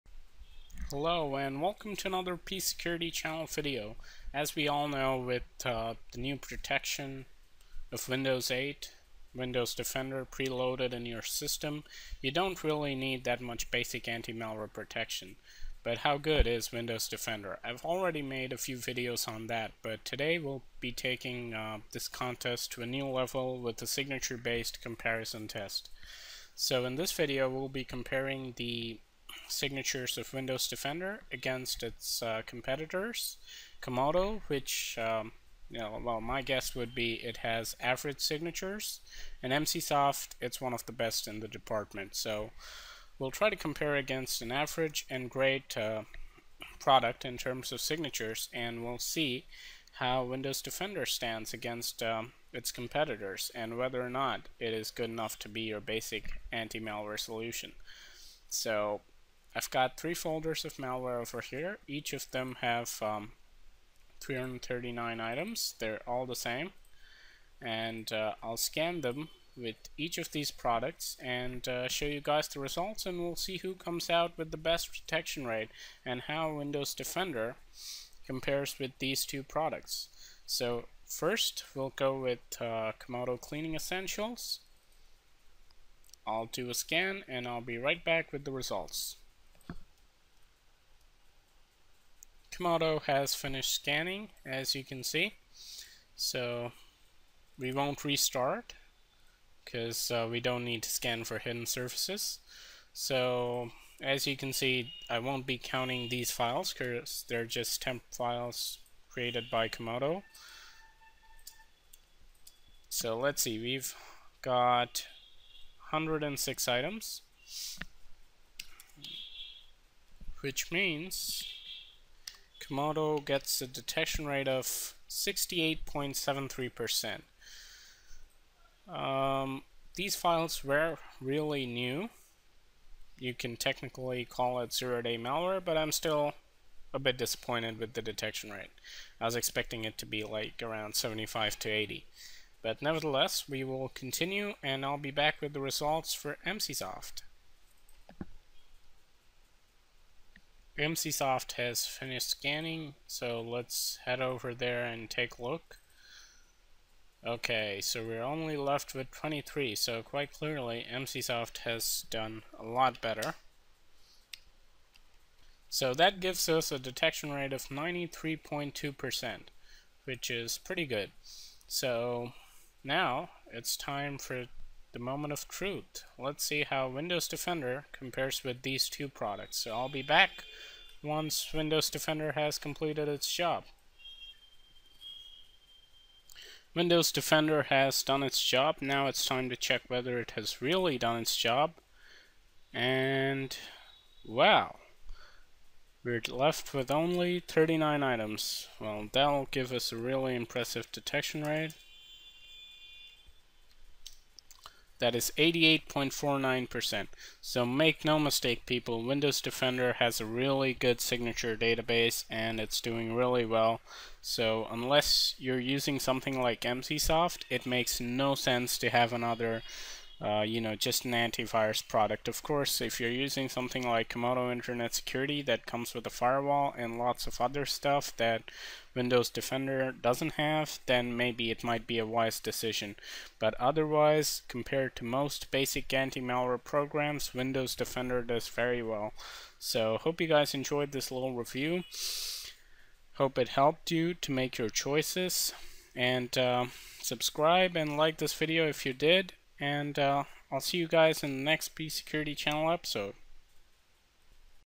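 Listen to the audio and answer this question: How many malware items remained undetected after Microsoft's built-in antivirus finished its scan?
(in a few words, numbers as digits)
39.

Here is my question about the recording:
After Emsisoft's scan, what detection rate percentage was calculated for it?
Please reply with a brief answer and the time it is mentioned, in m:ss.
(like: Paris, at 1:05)
93.2%, at 2:47.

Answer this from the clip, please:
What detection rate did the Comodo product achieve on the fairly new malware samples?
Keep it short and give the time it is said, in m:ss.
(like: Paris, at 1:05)
68.73%, at 2:05.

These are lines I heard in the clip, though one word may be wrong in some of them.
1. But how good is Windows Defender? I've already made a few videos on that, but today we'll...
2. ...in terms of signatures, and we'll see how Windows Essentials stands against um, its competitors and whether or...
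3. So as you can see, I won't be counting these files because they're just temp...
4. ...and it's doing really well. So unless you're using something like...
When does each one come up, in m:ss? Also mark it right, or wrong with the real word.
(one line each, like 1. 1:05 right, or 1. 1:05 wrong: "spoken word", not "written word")
1. 0:15 right
2. 0:47 wrong: "Defender", not "Essentials"
3. 1:42 right
4. 3:32 right.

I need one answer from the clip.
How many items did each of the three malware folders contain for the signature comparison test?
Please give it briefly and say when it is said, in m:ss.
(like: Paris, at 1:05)
339, at 1:04.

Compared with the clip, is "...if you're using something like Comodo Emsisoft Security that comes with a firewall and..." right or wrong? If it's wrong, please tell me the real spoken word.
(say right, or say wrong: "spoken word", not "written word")
wrong: "Internet", not "Emsisoft".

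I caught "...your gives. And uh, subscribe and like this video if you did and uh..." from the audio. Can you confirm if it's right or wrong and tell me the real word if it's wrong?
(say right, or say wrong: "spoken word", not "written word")
wrong: "choices", not "gives".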